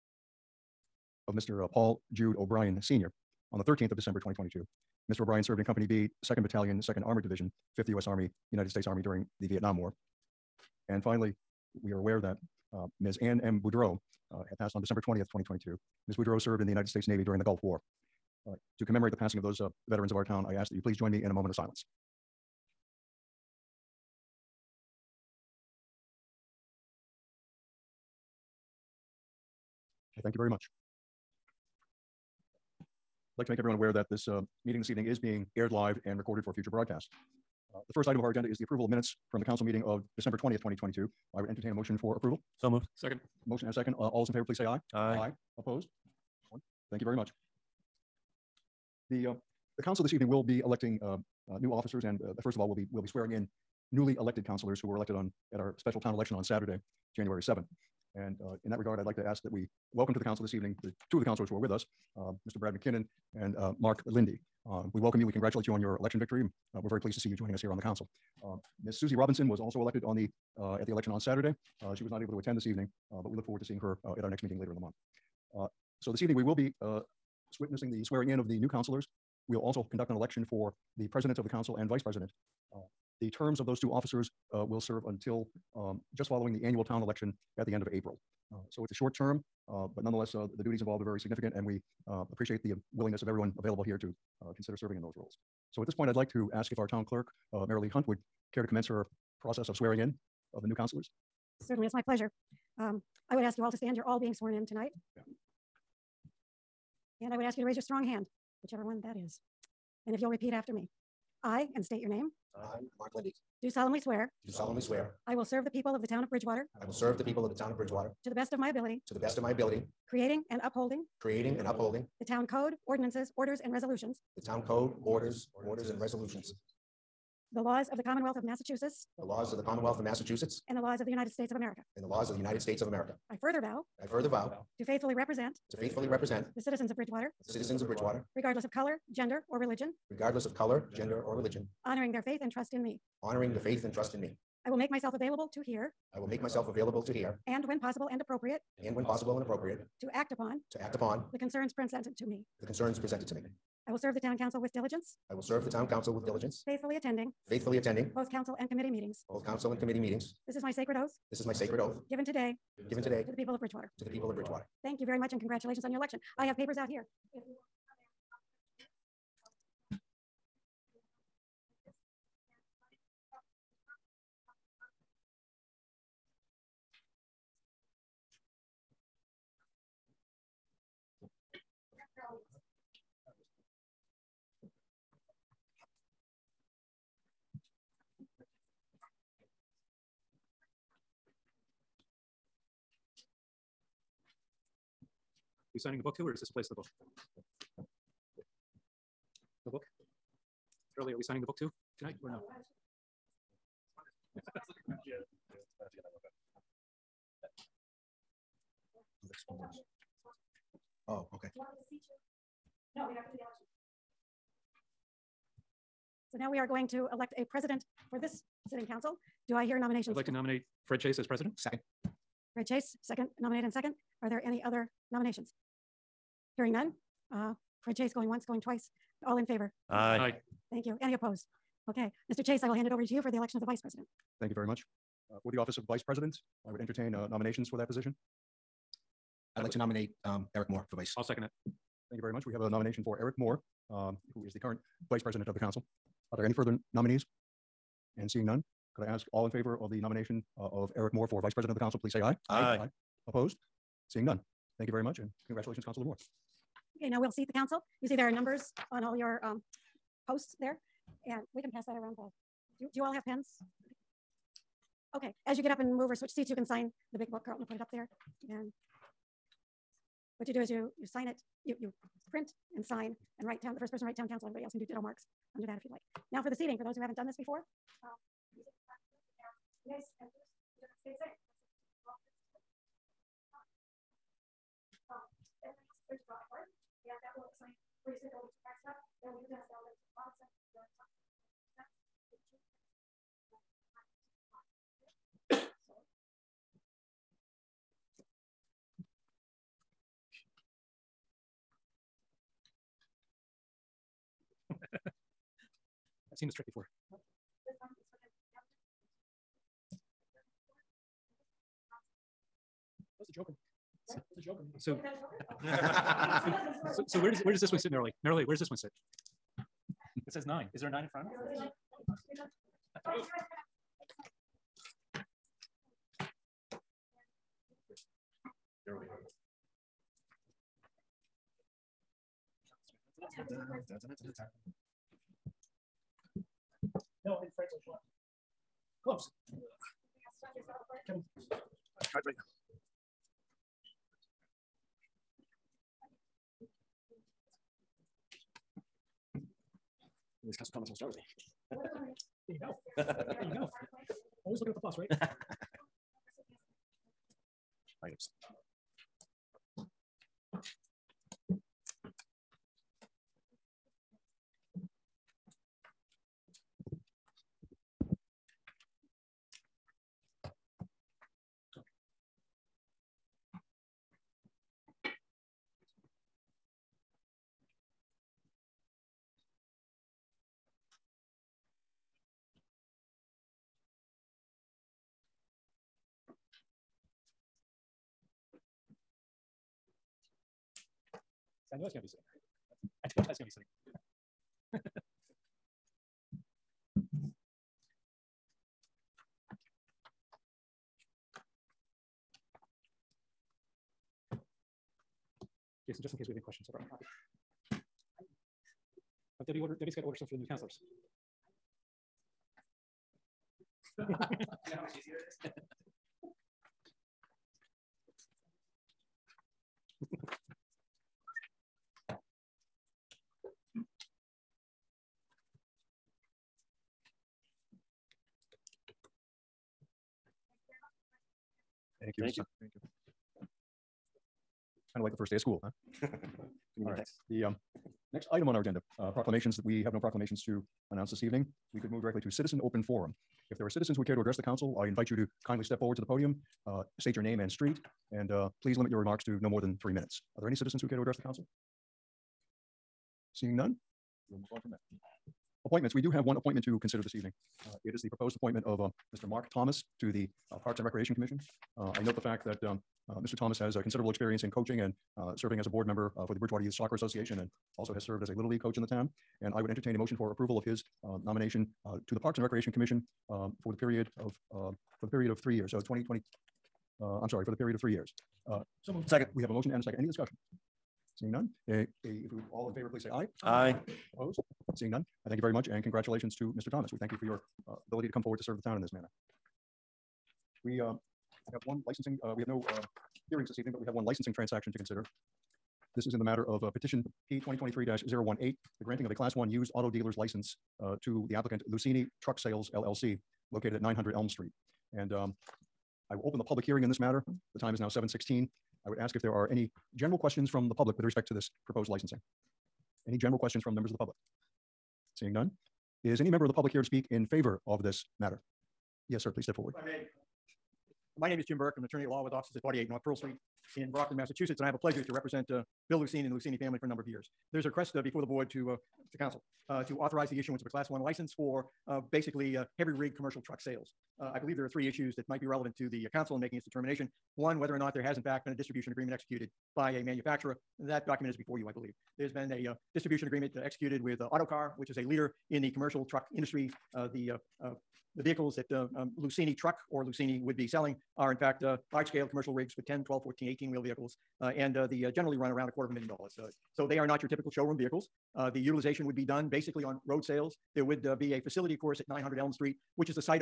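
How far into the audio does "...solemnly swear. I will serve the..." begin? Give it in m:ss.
1:54.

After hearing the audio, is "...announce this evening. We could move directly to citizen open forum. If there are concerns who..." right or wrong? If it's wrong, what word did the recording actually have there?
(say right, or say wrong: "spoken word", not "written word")
wrong: "citizens", not "concerns".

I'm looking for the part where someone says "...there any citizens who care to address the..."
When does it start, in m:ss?
7:30.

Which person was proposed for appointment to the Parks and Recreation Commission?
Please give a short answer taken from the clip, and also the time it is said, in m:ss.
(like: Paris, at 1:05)
Mark Thomas, at 7:39.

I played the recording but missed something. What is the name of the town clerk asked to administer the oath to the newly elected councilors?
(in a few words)
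Lee Hunt.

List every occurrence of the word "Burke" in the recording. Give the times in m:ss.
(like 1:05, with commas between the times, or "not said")
8:41.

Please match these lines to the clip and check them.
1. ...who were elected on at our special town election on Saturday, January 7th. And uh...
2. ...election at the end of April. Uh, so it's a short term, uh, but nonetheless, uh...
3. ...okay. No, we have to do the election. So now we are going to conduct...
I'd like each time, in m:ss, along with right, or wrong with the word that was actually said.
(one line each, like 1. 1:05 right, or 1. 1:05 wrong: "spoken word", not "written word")
1. 0:54 right
2. 1:27 right
3. 3:31 wrong: "elect", not "conduct".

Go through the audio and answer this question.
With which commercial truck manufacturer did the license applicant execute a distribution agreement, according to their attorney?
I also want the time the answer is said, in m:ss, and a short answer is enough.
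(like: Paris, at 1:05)
Autocar, at 9:04.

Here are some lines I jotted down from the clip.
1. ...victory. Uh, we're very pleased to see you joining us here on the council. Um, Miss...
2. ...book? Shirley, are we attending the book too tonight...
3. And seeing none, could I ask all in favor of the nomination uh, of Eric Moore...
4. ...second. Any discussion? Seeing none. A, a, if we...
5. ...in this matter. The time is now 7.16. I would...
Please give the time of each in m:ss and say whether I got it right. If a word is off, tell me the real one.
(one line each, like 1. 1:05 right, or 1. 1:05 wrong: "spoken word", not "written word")
1. 1:06 right
2. 3:19 wrong: "signing", not "attending"
3. 4:08 right
4. 7:59 right
5. 8:26 right.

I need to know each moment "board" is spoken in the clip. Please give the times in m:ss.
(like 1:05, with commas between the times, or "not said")
7:45, 8:48.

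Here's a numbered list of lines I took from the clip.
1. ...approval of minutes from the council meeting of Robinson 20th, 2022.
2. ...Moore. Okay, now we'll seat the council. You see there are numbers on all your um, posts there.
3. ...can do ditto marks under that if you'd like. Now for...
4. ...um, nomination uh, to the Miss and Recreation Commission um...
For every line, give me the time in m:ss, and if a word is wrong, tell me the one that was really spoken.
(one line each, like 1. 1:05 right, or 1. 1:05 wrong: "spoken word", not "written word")
1. 0:38 wrong: "December", not "Robinson"
2. 4:16 right
3. 4:34 right
4. 7:51 wrong: "Parks", not "Miss".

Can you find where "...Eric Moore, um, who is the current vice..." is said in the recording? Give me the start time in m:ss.
4:03.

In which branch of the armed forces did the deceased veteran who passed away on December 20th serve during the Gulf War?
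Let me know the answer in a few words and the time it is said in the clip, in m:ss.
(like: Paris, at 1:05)
United States Navy, at 0:16.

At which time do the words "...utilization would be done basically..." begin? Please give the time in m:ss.
9:18.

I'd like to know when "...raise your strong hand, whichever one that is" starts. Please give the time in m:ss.
1:47.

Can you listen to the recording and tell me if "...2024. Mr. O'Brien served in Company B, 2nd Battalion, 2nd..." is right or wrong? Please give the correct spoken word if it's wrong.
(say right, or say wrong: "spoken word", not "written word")
wrong: "2022", not "2024".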